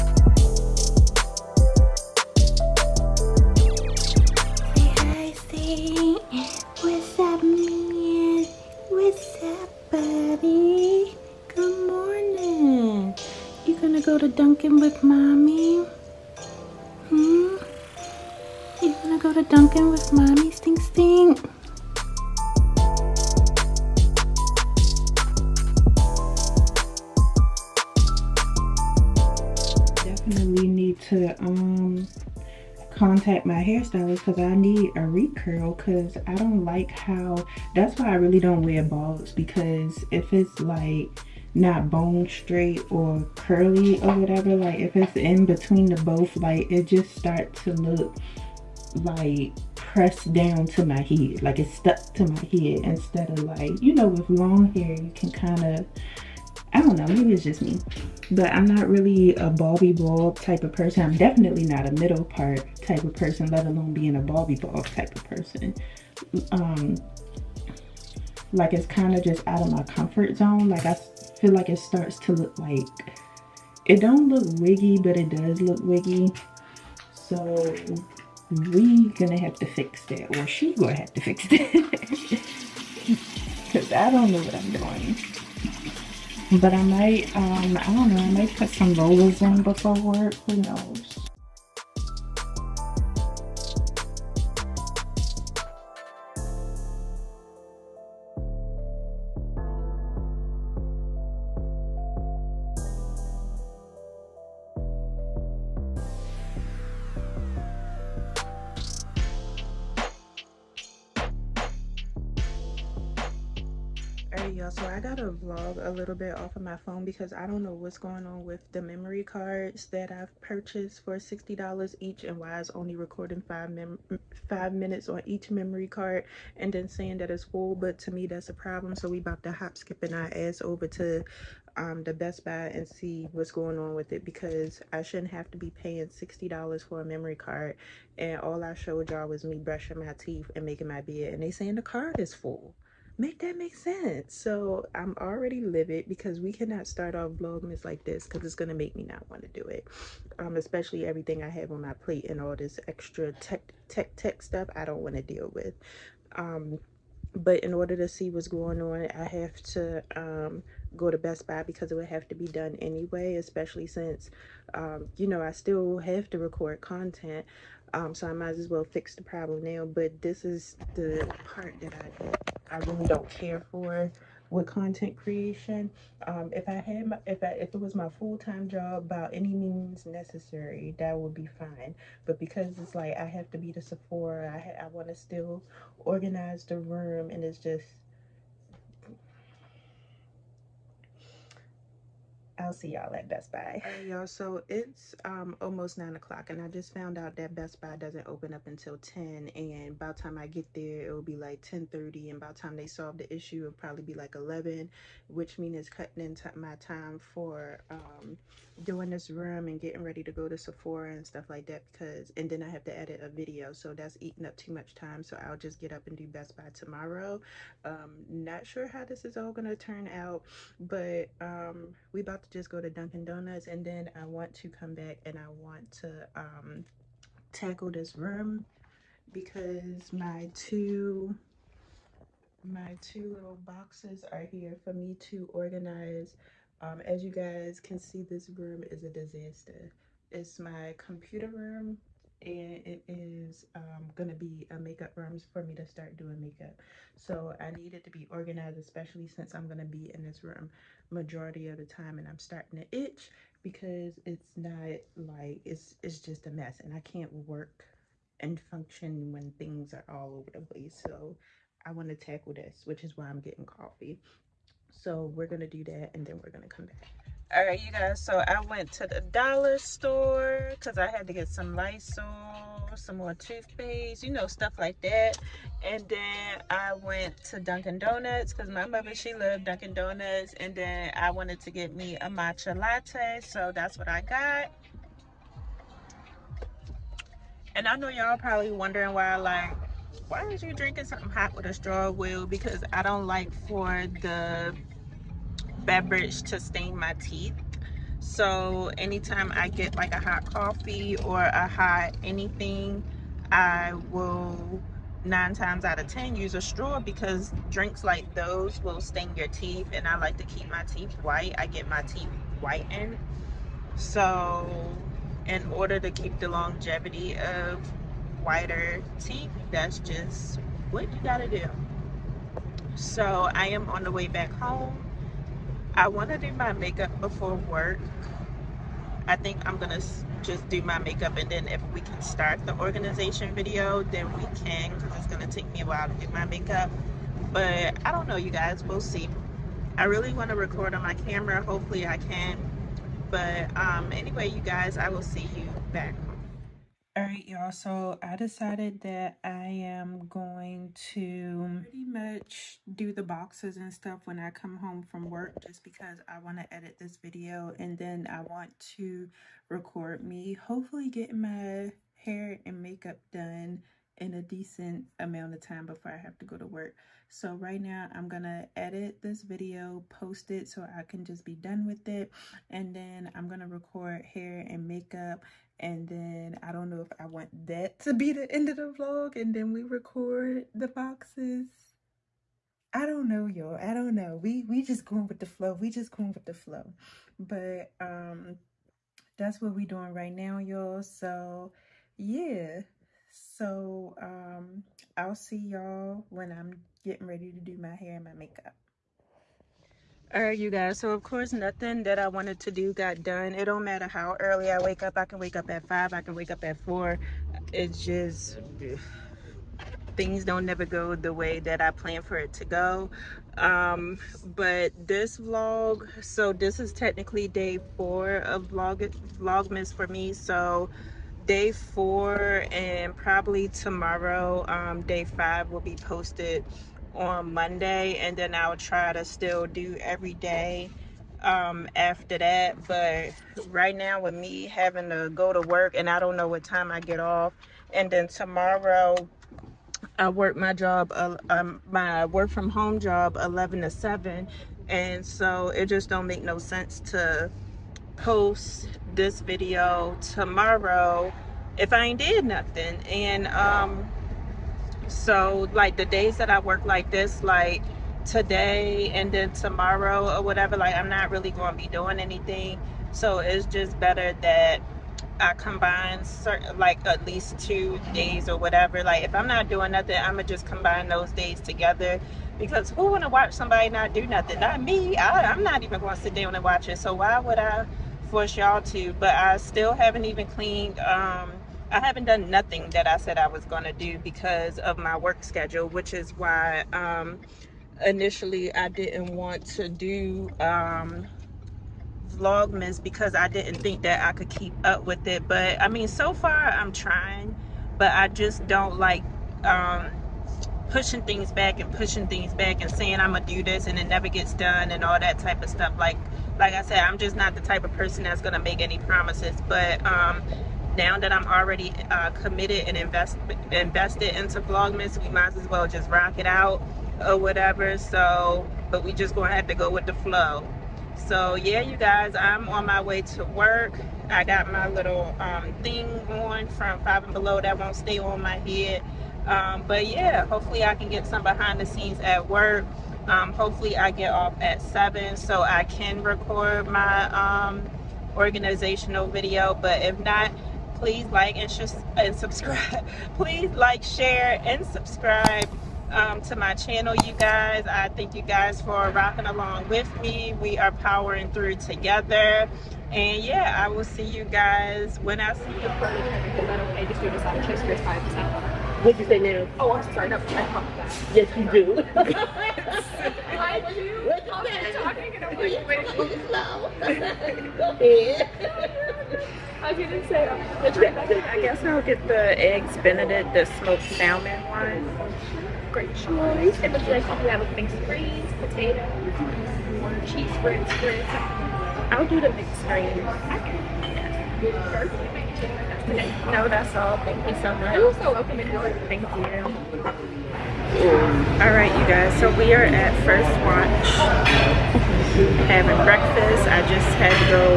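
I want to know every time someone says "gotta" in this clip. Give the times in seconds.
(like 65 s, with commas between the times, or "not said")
114 s, 321 s.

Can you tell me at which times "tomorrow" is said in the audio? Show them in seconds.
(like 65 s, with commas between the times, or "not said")
216 s, 423 s, 438 s, 450 s, 459 s.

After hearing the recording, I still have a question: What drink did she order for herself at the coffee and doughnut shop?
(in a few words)
Matcha latte.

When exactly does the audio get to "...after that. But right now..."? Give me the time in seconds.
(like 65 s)
431 s.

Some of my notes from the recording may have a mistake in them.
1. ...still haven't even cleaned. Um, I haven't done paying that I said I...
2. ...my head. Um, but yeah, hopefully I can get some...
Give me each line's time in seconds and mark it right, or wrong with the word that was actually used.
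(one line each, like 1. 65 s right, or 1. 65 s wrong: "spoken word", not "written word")
1. 479 s wrong: "nothing", not "paying"
2. 528 s right.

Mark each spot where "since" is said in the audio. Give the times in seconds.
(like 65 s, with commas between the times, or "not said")
163 s, 249 s.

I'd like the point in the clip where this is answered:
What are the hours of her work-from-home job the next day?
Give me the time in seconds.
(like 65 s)
443 s.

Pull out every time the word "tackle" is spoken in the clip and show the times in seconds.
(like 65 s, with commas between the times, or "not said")
227 s, 262 s.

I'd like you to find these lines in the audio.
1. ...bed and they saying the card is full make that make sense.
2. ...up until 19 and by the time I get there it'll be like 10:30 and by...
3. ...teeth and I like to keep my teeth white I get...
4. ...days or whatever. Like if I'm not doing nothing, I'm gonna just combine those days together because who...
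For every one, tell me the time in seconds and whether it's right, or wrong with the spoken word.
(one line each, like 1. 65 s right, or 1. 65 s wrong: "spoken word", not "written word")
1. 141 s right
2. 198 s wrong: "10", not "19"
3. 309 s right
4. 468 s right.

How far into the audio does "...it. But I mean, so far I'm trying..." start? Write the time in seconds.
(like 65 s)
495 s.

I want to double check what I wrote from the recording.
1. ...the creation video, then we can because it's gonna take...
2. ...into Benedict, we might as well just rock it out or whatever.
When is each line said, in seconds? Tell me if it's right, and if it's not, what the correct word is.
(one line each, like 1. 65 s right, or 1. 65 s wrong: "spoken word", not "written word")
1. 332 s wrong: "organization", not "creation"
2. 514 s wrong: "Vlogmas", not "Benedict".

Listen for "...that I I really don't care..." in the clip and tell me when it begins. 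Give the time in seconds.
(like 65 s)
171 s.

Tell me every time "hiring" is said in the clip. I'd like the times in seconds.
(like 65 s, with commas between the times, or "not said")
not said.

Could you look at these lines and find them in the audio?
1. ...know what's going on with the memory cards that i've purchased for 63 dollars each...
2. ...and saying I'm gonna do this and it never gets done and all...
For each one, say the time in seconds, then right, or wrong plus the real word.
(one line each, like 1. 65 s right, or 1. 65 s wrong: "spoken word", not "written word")
1. 117 s wrong: "60", not "63"
2. 502 s right.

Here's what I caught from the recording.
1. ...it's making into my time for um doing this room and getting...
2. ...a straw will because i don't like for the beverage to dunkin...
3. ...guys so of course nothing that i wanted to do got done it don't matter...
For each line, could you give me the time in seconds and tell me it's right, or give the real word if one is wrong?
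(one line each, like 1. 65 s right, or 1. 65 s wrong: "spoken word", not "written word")
1. 205 s wrong: "cutting", not "making"
2. 291 s wrong: "stain", not "dunkin"
3. 400 s right.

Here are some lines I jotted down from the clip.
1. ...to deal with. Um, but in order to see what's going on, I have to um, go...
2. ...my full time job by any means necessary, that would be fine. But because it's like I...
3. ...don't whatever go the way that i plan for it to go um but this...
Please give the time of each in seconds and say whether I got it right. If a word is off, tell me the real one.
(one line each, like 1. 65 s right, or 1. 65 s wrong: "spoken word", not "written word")
1. 155 s right
2. 177 s right
3. 410 s wrong: "never", not "whatever".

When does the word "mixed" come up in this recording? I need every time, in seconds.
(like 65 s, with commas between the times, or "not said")
577 s, 582 s.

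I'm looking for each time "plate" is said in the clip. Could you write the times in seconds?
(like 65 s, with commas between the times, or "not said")
151 s.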